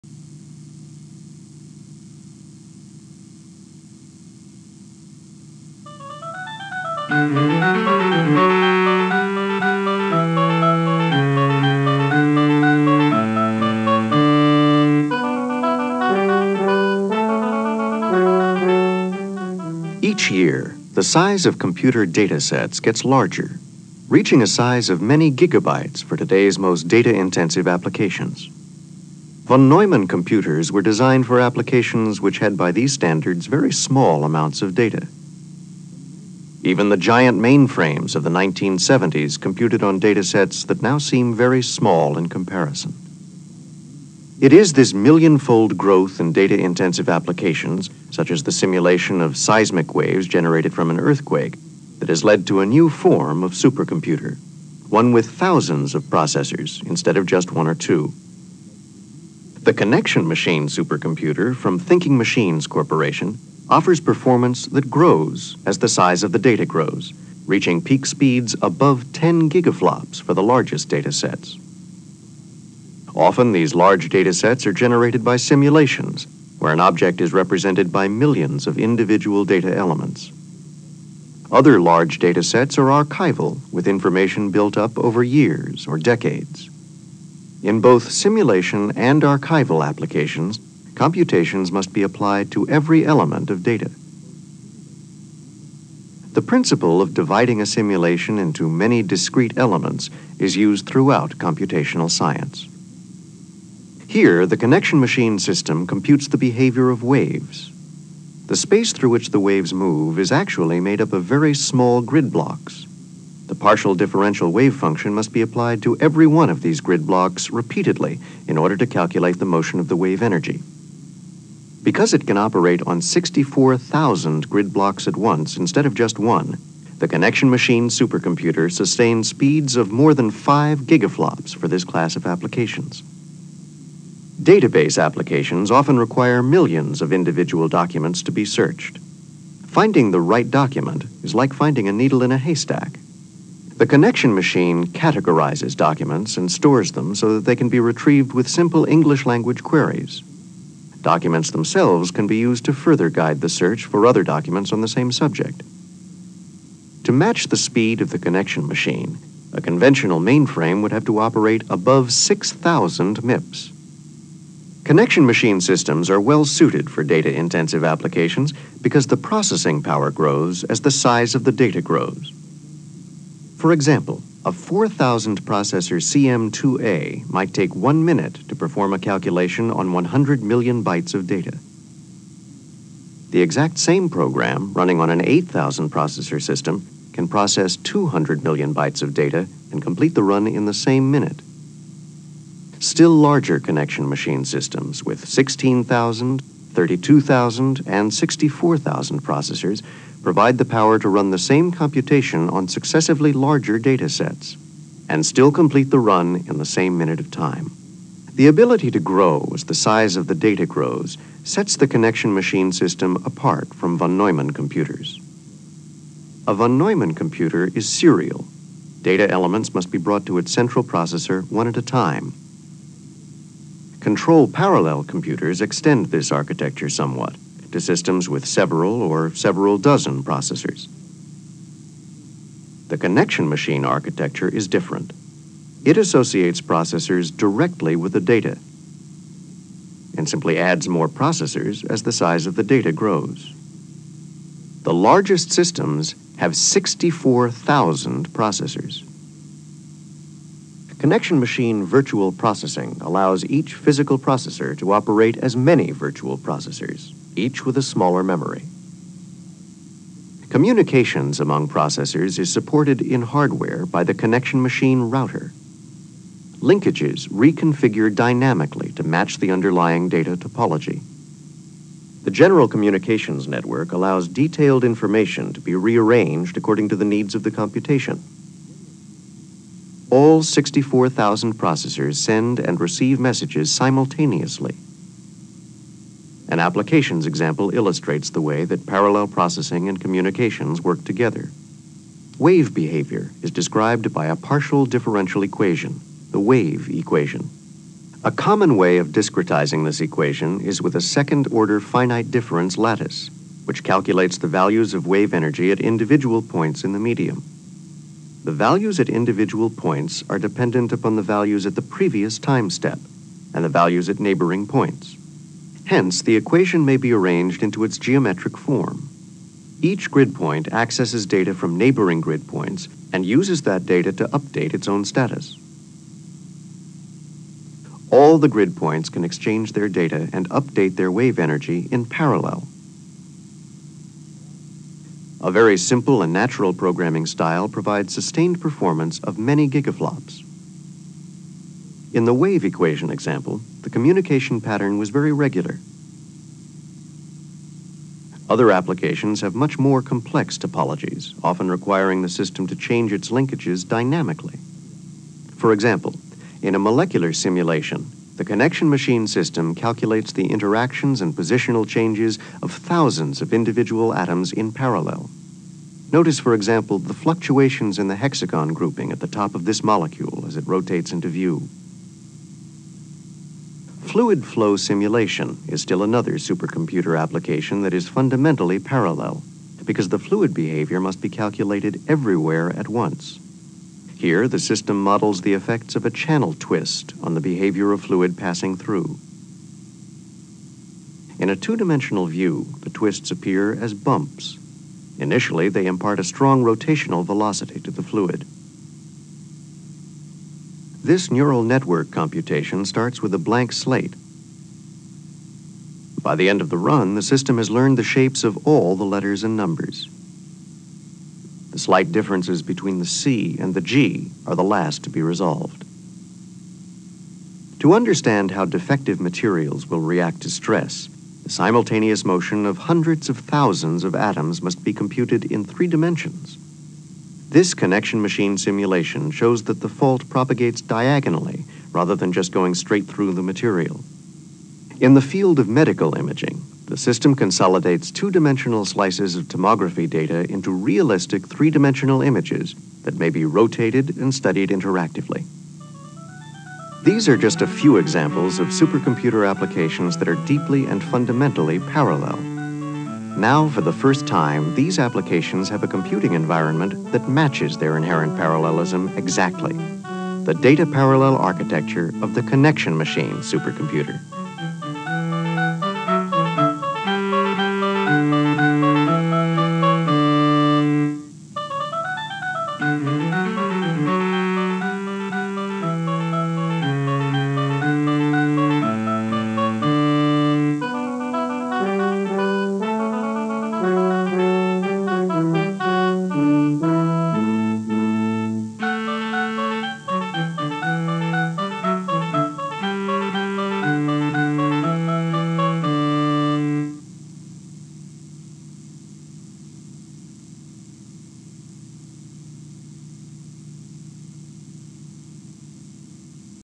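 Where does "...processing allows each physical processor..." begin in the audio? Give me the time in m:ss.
4:12.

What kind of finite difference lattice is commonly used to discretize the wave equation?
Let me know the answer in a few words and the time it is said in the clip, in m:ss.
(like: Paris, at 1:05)
second-order, at 5:01.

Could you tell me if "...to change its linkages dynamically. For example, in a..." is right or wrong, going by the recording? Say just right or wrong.
right.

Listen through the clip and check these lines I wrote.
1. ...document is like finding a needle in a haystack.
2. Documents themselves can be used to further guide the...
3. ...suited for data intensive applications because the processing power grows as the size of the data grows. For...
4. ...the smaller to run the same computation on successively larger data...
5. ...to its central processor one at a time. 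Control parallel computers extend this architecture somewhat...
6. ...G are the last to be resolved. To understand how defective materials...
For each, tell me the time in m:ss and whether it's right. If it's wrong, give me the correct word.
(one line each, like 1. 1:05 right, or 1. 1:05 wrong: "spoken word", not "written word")
1. 2:20 right
2. 2:31 right
3. 2:46 right
4. 3:20 wrong: "power", not "smaller"
5. 3:40 right
6. 6:53 right.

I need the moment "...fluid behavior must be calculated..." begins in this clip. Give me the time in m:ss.
6:20.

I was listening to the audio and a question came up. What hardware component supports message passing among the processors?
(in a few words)
the connection machine router.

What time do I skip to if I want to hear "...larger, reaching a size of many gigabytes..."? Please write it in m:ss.
0:23.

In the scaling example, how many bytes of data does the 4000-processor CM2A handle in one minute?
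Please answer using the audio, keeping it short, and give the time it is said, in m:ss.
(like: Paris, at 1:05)
100 million bytes, at 2:59.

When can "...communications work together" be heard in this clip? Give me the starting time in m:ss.
4:50.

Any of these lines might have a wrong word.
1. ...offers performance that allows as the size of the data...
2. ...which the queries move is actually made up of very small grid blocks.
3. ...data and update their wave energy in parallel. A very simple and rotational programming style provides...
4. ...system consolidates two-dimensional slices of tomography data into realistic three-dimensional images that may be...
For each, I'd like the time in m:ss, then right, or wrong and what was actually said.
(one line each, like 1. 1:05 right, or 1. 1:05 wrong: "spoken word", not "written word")
1. 1:03 wrong: "grows", not "allows"
2. 1:49 wrong: "waves", not "queries"
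3. 5:29 wrong: "natural", not "rotational"
4. 7:16 right.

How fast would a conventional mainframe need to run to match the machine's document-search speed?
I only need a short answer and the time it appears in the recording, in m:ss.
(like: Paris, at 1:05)
above 6,000 MIPS, at 2:41.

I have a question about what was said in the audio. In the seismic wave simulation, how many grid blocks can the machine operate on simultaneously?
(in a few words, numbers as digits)
64,000.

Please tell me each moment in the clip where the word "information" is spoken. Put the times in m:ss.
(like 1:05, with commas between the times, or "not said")
1:23, 4:34.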